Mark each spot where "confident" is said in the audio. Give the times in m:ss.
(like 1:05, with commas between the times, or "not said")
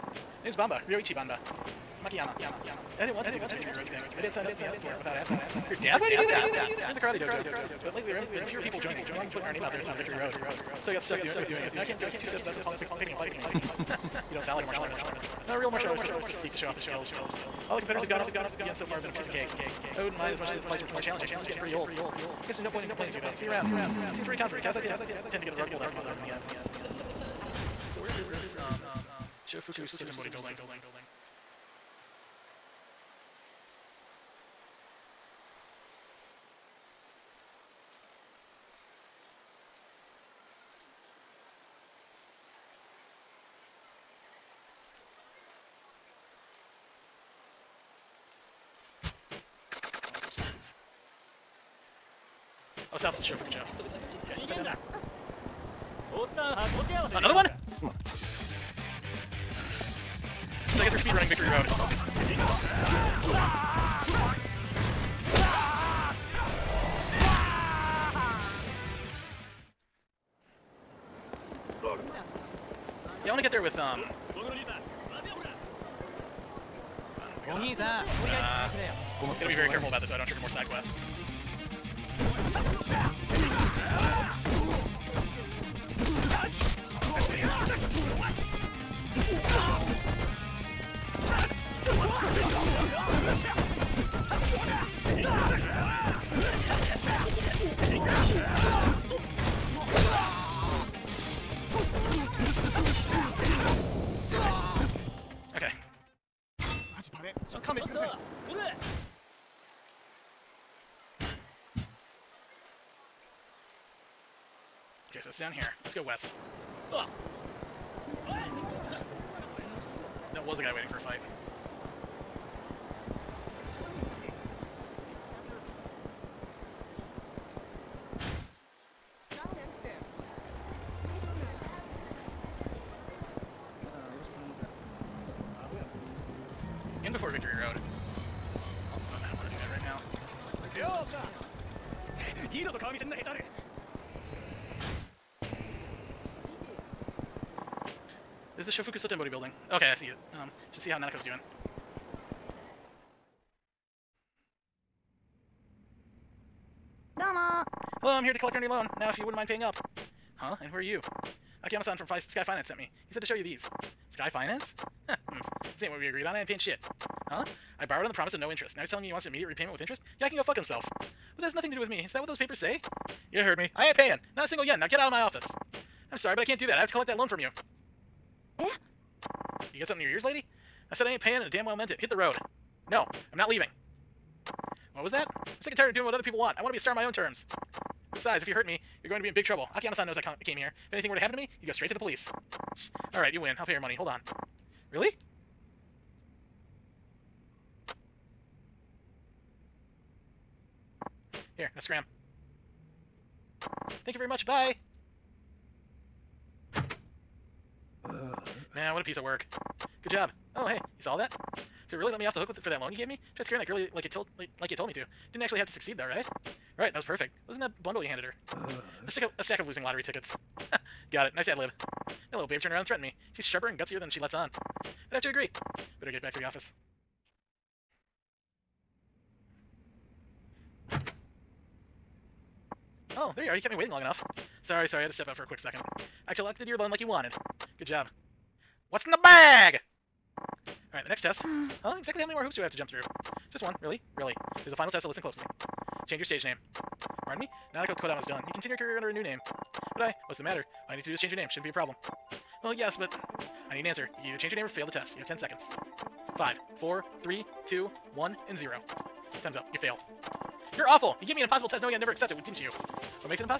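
0:24.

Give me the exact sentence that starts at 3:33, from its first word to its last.
Tried scaring that girl like you told like, like you told me to.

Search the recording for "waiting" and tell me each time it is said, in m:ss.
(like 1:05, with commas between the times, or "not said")
2:00, 3:53.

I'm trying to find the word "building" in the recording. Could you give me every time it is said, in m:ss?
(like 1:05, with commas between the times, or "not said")
0:30, 2:29.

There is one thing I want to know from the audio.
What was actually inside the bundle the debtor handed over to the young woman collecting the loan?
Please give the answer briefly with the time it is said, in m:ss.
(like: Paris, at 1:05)
Losing lottery tickets, at 3:39.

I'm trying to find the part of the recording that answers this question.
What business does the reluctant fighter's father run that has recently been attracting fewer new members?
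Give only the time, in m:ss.
0:06.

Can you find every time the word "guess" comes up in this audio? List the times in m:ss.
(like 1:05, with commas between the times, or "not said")
0:22, 1:00.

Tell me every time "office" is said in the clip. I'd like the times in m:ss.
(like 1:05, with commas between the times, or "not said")
2:55, 3:46.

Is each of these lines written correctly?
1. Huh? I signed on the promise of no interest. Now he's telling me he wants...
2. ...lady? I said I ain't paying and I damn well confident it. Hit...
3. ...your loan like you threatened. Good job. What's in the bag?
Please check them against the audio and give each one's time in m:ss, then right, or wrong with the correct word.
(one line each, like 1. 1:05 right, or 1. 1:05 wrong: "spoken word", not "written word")
1. 2:47 wrong: "borrowed", not "signed"
2. 3:00 wrong: "meant", not "confident"
3. 3:56 wrong: "wanted", not "threatened".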